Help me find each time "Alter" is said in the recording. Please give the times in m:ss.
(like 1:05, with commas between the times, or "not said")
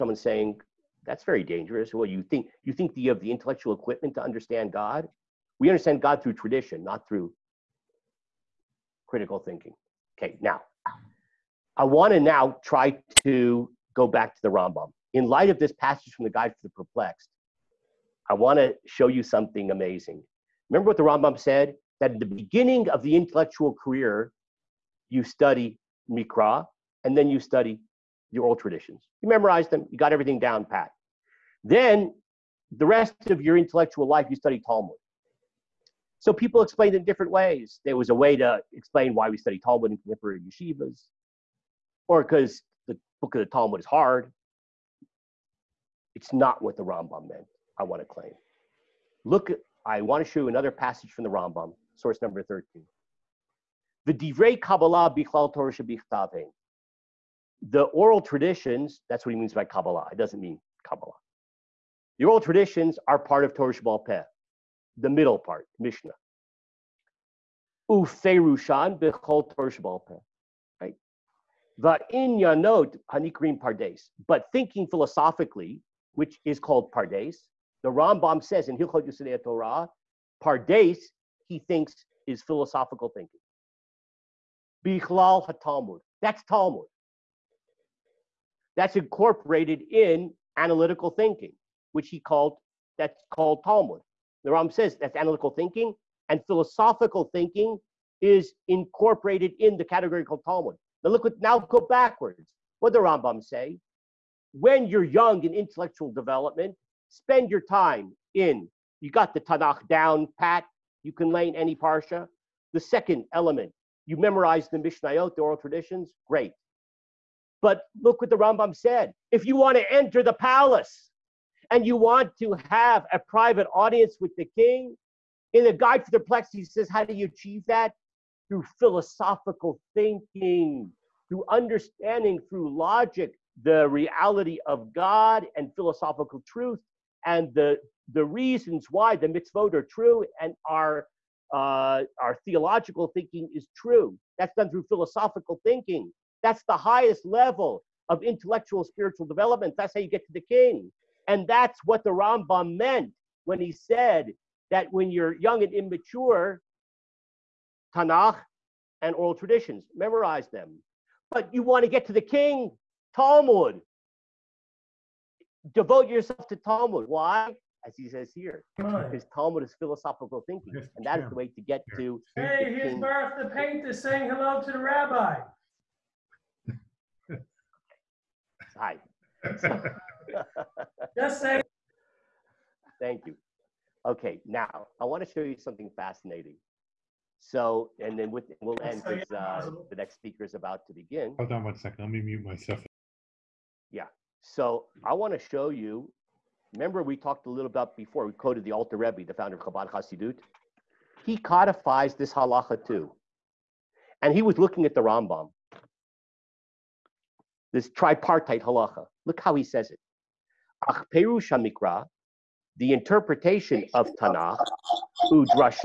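3:18.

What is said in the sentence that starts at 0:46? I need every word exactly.
It's not what the Rambam meant, I want to claim.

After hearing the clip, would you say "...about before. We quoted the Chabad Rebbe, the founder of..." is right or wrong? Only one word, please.
wrong.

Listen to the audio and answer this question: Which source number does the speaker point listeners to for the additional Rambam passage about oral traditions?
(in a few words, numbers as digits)
13.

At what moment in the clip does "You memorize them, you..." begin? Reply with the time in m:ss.
0:29.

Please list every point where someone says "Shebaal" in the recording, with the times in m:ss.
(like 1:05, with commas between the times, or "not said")
1:03, 1:09.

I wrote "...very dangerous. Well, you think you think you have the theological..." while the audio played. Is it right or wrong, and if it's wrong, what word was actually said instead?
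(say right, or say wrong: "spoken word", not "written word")
wrong: "intellectual", not "theological".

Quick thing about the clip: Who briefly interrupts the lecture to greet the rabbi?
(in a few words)
Barth the painter.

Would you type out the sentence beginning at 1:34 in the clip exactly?
The Ram says that's analytical thinking, and philosophical thinking is incorporated in the category called Talmud.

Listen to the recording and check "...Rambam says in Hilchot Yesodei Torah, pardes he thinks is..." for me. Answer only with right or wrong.
right.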